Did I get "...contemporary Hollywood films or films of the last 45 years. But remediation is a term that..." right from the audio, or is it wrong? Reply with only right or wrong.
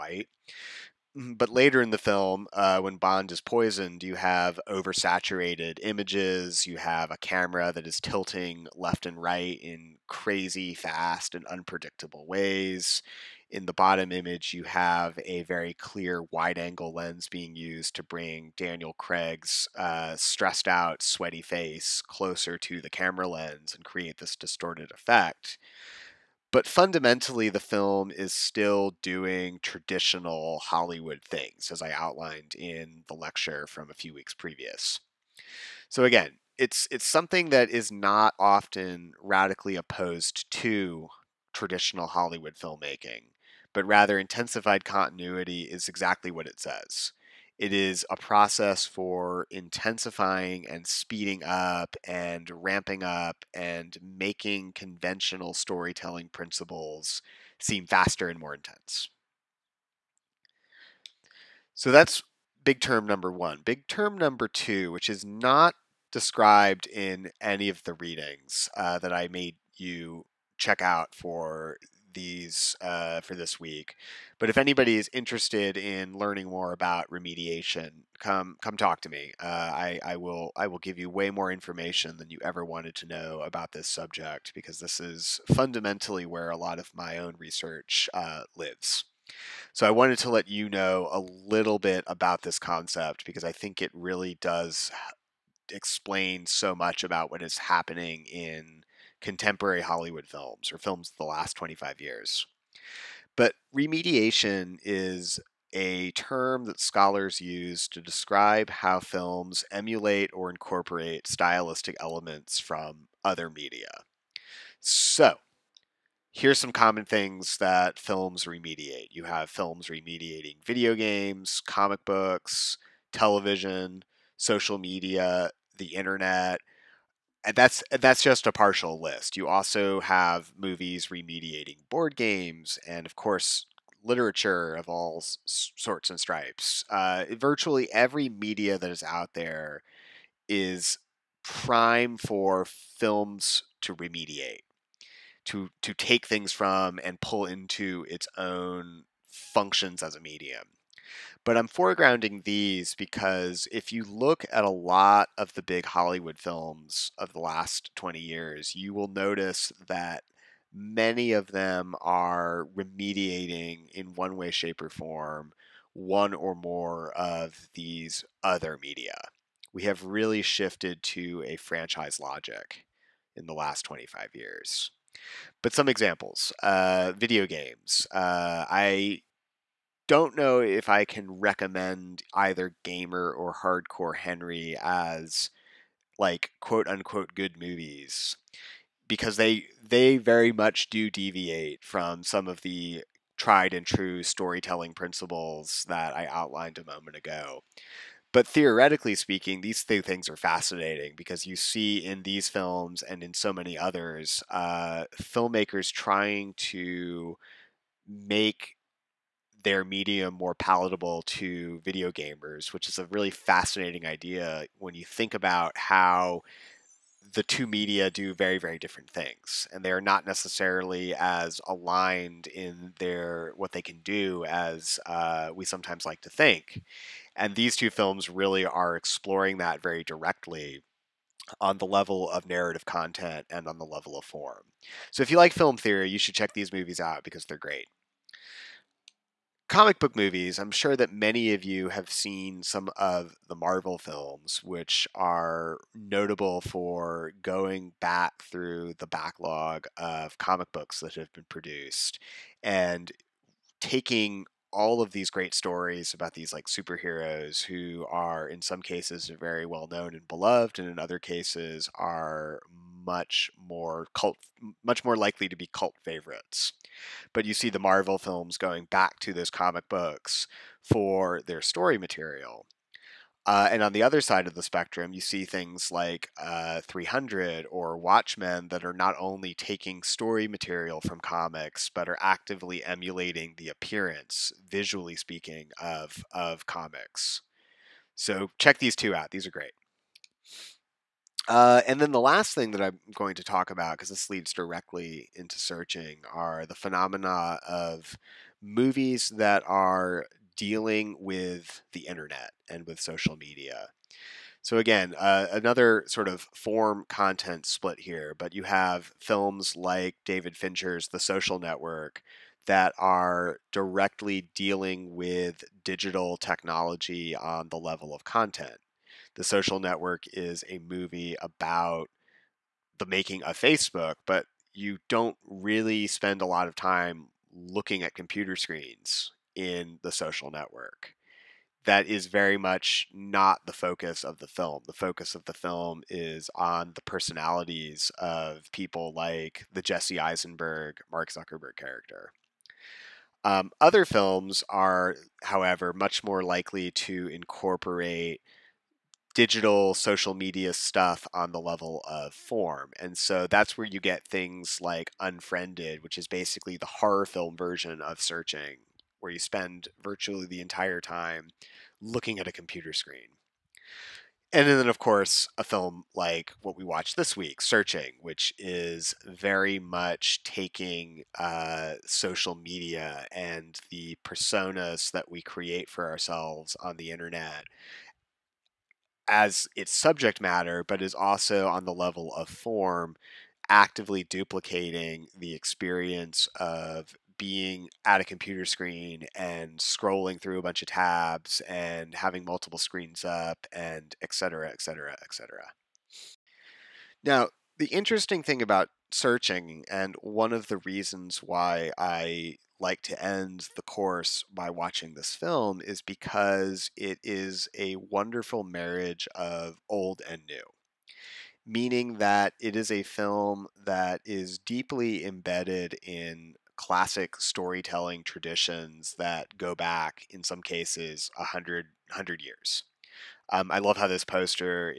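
wrong.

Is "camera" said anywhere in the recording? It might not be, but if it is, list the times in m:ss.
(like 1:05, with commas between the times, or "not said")
0:07, 0:22.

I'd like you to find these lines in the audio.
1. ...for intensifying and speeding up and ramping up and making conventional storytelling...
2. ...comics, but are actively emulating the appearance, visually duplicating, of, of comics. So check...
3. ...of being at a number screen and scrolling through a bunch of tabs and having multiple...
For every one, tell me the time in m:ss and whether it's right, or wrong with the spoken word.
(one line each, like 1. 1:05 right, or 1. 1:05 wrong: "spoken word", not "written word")
1. 0:48 right
2. 4:41 wrong: "speaking", not "duplicating"
3. 6:26 wrong: "computer", not "number".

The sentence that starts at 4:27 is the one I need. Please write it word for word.
But you see the Marvel films going back to those comic books for their story material.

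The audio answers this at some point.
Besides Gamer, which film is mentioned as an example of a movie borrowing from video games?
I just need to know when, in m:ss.
3:03.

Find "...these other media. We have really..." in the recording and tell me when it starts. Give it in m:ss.
2:47.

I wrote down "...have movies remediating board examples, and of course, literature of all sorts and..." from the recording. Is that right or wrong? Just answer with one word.
wrong.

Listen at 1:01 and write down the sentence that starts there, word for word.
So that's big term number one.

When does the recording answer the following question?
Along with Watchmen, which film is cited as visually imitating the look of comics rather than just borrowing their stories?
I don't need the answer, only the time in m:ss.
4:36.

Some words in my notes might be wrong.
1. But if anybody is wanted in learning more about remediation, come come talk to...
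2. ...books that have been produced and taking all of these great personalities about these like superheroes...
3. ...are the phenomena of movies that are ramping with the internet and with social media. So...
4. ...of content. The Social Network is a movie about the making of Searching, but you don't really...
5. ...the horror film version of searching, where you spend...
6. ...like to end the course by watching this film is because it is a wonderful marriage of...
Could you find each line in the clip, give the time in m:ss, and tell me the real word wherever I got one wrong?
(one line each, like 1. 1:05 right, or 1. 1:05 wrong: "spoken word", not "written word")
1. 1:14 wrong: "interested", not "wanted"
2. 4:10 wrong: "stories", not "personalities"
3. 4:56 wrong: "dealing", not "ramping"
4. 5:18 wrong: "Facebook", not "Searching"
5. 5:56 right
6. 6:42 right.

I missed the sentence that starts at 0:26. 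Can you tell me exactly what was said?
But fundamentally, the film is still doing traditional Hollywood things, as I outlined in the lecture from a few weeks previous.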